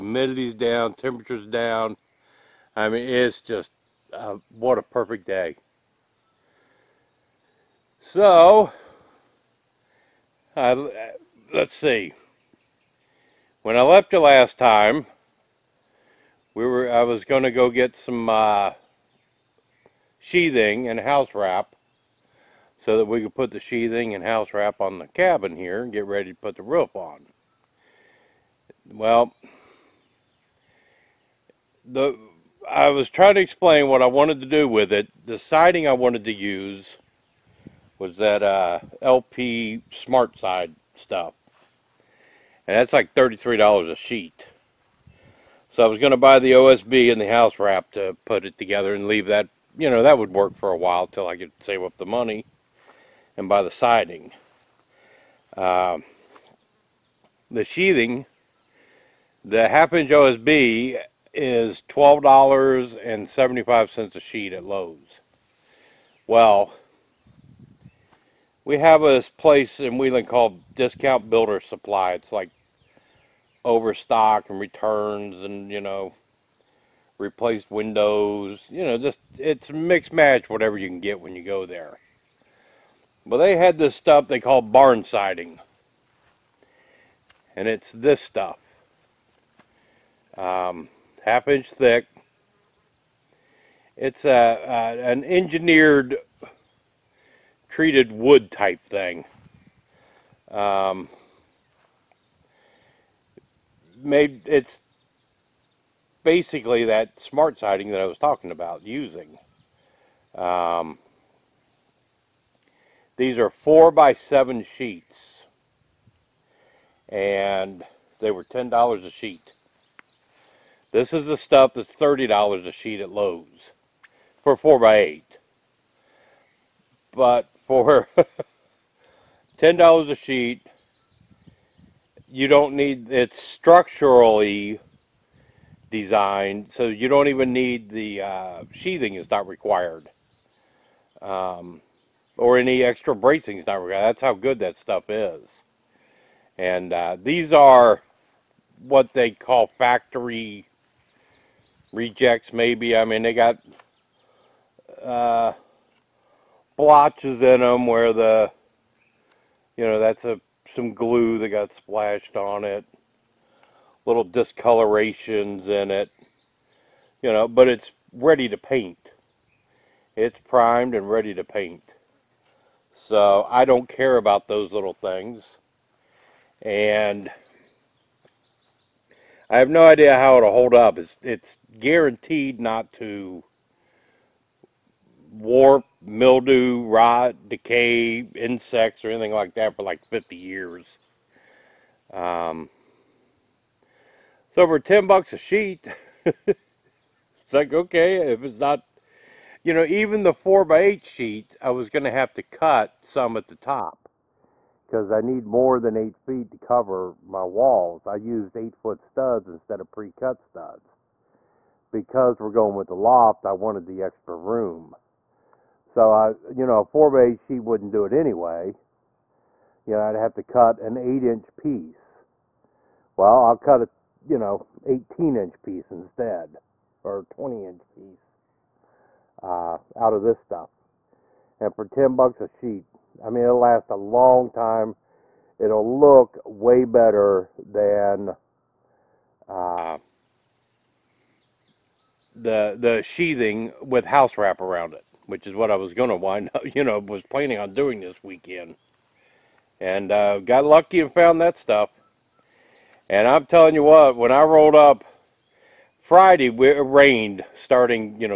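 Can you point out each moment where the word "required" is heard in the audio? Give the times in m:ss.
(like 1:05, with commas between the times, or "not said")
2:19, 2:23.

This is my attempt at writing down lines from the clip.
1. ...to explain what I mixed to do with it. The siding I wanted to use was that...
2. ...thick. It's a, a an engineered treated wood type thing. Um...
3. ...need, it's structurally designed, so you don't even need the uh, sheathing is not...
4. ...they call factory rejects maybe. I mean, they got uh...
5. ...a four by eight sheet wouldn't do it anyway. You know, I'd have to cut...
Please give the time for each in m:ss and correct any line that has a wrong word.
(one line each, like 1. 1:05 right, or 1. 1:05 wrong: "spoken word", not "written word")
1. 0:33 wrong: "wanted", not "mixed"
2. 1:31 right
3. 2:12 right
4. 2:29 right
5. 3:36 right.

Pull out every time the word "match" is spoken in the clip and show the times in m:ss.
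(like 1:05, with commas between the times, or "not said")
1:20.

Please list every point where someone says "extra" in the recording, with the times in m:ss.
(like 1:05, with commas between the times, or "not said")
2:22, 3:34.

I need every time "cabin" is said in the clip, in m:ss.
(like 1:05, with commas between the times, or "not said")
0:25.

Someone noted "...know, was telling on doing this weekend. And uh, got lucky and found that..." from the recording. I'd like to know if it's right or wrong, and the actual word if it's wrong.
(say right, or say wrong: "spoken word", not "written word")
wrong: "planning", not "telling".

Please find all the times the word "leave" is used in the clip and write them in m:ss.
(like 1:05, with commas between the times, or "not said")
0:49.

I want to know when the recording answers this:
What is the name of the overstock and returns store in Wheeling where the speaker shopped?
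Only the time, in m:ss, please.
1:10.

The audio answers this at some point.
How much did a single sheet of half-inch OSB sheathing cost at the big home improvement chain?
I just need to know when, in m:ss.
1:01.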